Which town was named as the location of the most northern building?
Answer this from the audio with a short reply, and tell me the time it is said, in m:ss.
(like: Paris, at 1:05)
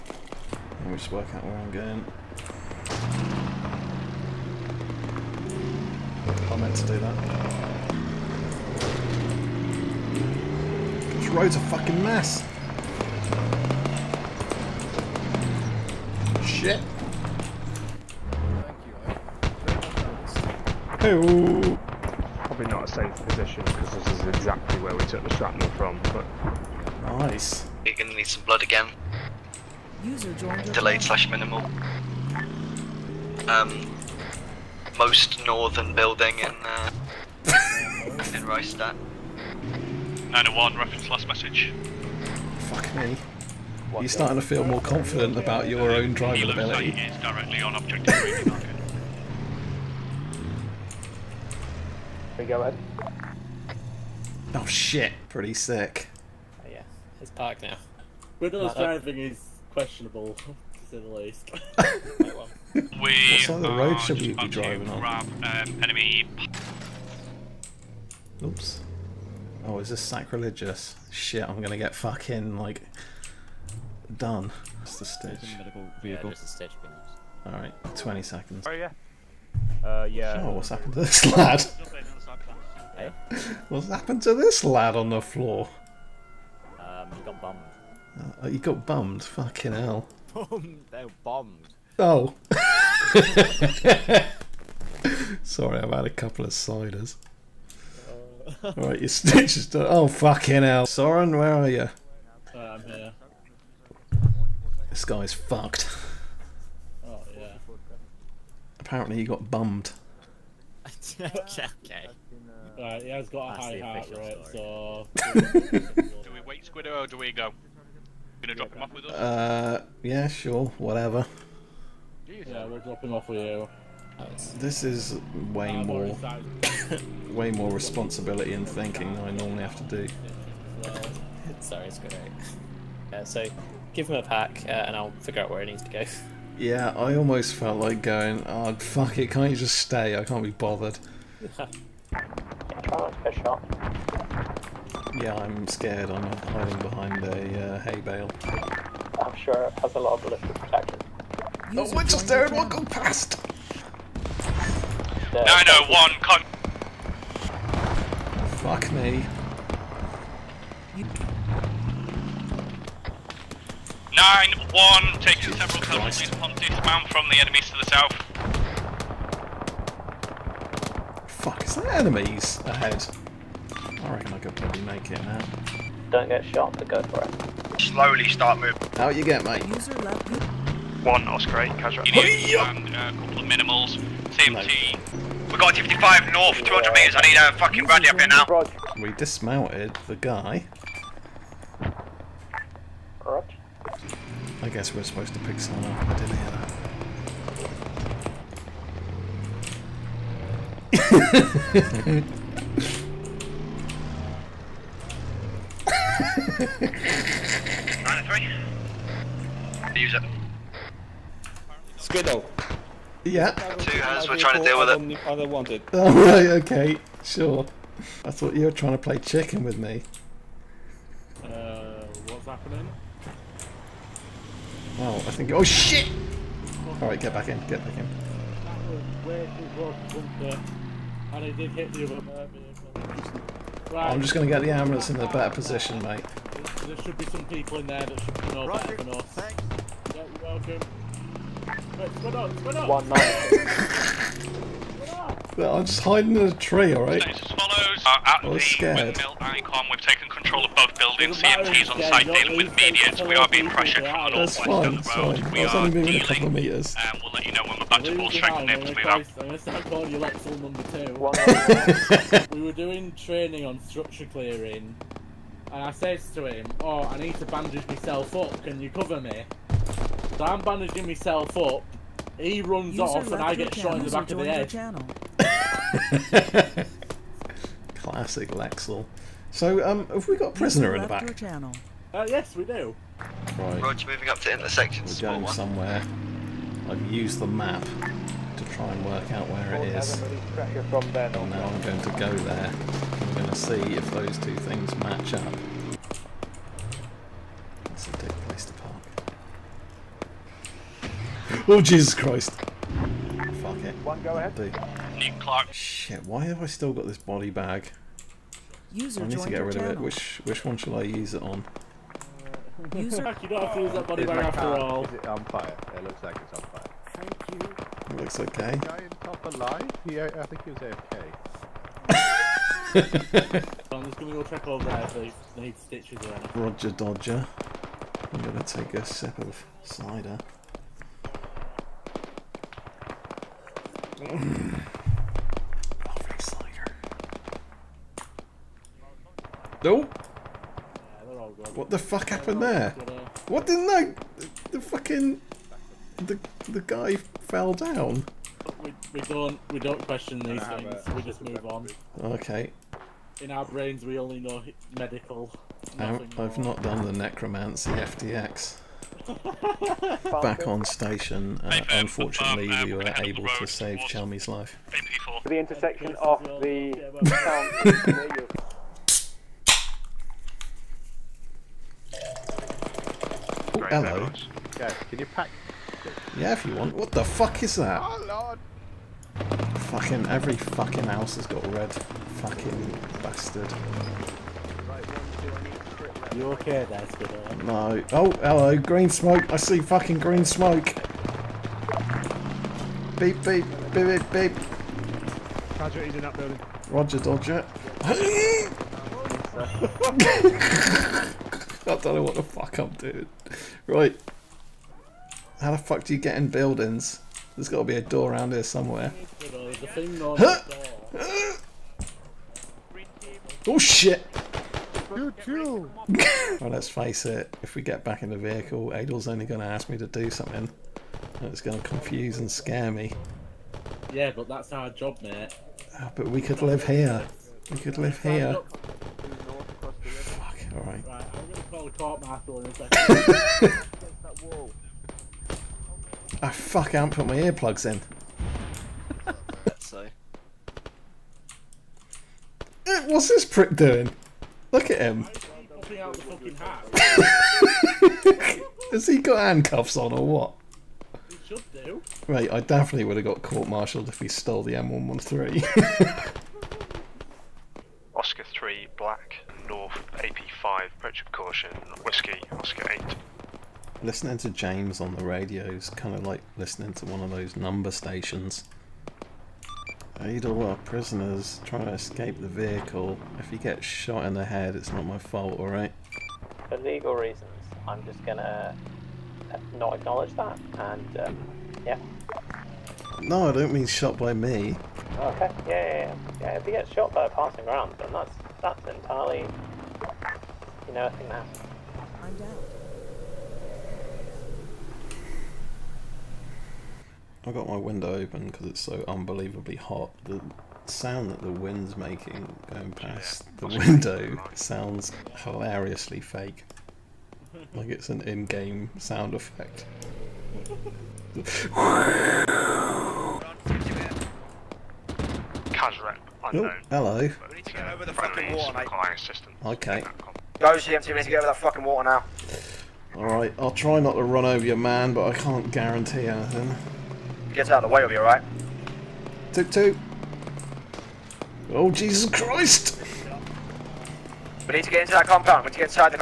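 Reichstadt, at 0:38.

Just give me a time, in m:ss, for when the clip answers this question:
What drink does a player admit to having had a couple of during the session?
1:36.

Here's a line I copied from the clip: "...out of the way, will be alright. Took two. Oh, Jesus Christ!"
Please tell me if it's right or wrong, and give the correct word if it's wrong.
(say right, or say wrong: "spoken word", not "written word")
right.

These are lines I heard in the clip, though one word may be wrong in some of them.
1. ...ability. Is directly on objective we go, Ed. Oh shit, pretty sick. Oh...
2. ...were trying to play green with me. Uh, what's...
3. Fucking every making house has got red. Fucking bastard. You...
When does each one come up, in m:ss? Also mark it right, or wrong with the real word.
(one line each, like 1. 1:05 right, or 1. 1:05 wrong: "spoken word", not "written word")
1. 0:46 right
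2. 3:38 wrong: "chicken", not "green"
3. 6:19 wrong: "fucking", not "making".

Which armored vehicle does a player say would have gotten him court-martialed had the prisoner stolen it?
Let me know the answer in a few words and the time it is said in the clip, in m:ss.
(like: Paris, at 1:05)
M113, at 7:34.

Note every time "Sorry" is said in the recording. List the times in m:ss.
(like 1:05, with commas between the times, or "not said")
1:35, 2:11.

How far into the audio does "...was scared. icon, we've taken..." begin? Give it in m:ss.
4:08.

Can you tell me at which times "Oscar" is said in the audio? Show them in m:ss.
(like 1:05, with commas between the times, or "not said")
3:01, 7:38, 7:42.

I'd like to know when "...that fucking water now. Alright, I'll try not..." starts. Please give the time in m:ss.
8:41.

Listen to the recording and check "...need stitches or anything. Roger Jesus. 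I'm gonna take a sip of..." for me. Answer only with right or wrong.
wrong.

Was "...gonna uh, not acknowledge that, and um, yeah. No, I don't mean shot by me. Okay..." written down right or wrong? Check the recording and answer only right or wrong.
right.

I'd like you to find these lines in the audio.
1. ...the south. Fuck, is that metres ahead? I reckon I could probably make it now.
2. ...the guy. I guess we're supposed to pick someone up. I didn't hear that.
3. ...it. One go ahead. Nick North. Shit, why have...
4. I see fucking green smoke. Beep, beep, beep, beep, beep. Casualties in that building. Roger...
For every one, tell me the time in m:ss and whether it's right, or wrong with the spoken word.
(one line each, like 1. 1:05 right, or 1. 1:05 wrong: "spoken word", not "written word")
1. 2:47 wrong: "enemies", not "metres"
2. 3:10 right
3. 5:03 wrong: "Clark", not "North"
4. 6:29 right.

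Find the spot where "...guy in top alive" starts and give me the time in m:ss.
5:18.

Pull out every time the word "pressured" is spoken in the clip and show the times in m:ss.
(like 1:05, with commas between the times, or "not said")
4:13.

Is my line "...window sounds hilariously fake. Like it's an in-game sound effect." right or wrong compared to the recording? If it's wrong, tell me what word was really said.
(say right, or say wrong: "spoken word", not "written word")
right.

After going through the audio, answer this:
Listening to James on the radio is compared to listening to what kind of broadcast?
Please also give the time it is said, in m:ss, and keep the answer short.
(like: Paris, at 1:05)
Number stations, at 7:47.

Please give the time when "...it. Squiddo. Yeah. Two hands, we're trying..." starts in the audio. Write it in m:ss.
3:30.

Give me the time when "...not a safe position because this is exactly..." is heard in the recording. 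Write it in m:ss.
0:22.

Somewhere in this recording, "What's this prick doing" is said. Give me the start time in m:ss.
7:23.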